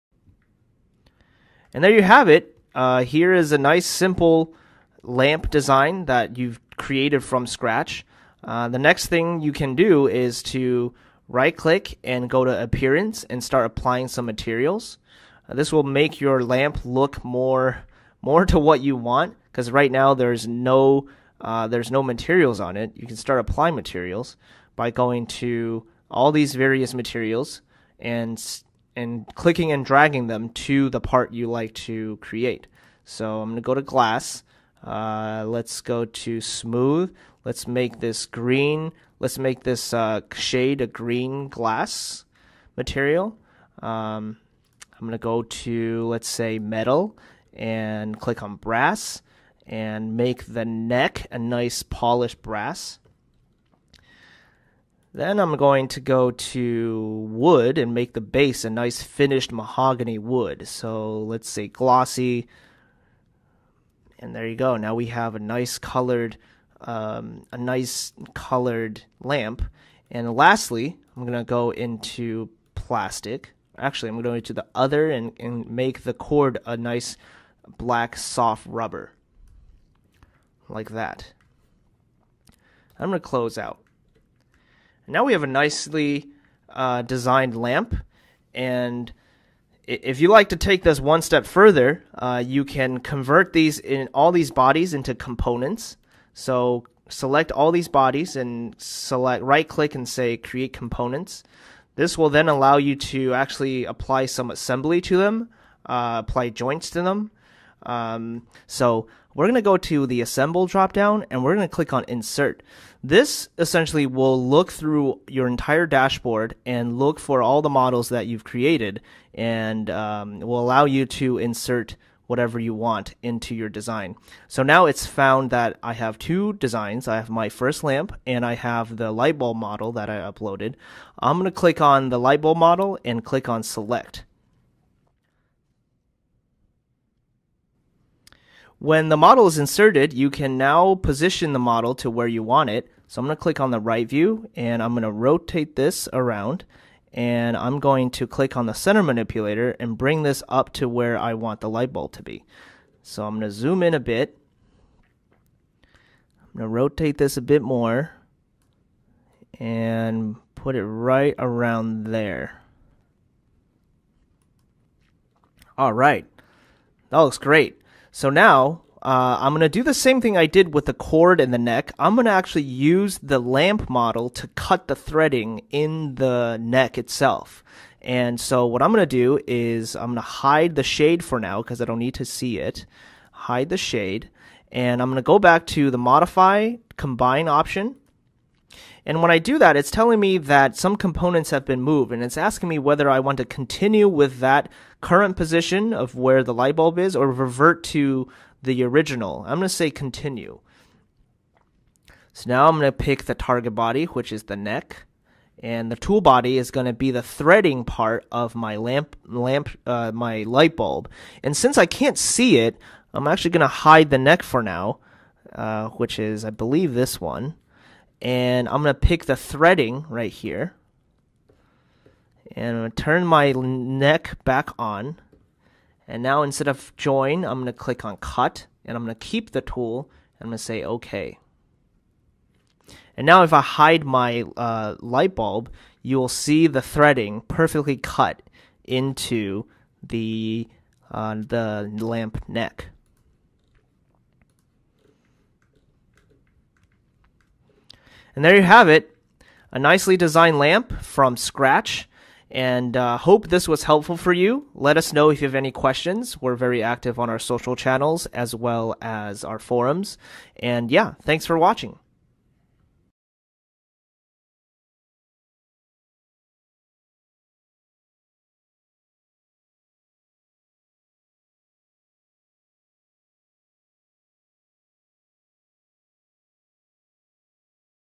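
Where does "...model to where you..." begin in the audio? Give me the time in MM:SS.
02:21.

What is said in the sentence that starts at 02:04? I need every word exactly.
So now it's found that I have two designs.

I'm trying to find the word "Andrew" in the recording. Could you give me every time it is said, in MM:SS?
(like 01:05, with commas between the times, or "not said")
not said.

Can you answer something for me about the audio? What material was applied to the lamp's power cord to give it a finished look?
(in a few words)
Black soft rubber.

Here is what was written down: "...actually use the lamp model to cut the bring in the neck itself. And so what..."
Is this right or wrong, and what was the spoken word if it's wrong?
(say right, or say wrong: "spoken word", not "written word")
wrong: "threading", not "bring".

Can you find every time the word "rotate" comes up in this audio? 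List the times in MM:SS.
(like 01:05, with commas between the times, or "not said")
02:25, 02:36.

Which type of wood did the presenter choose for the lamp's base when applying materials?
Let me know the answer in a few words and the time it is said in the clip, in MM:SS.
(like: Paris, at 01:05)
Mahogany, at 00:59.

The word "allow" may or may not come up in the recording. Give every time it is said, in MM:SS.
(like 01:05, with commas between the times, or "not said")
01:42, 02:00.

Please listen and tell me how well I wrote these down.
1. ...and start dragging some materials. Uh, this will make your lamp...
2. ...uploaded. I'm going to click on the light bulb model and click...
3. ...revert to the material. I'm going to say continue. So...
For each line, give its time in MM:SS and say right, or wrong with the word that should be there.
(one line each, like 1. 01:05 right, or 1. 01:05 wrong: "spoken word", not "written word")
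1. 00:13 wrong: "applying", not "dragging"
2. 02:10 right
3. 03:17 wrong: "original", not "material".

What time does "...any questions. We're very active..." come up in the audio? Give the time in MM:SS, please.
04:15.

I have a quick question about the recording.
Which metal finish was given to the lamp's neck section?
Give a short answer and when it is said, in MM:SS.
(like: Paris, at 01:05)
Polished brass, at 00:51.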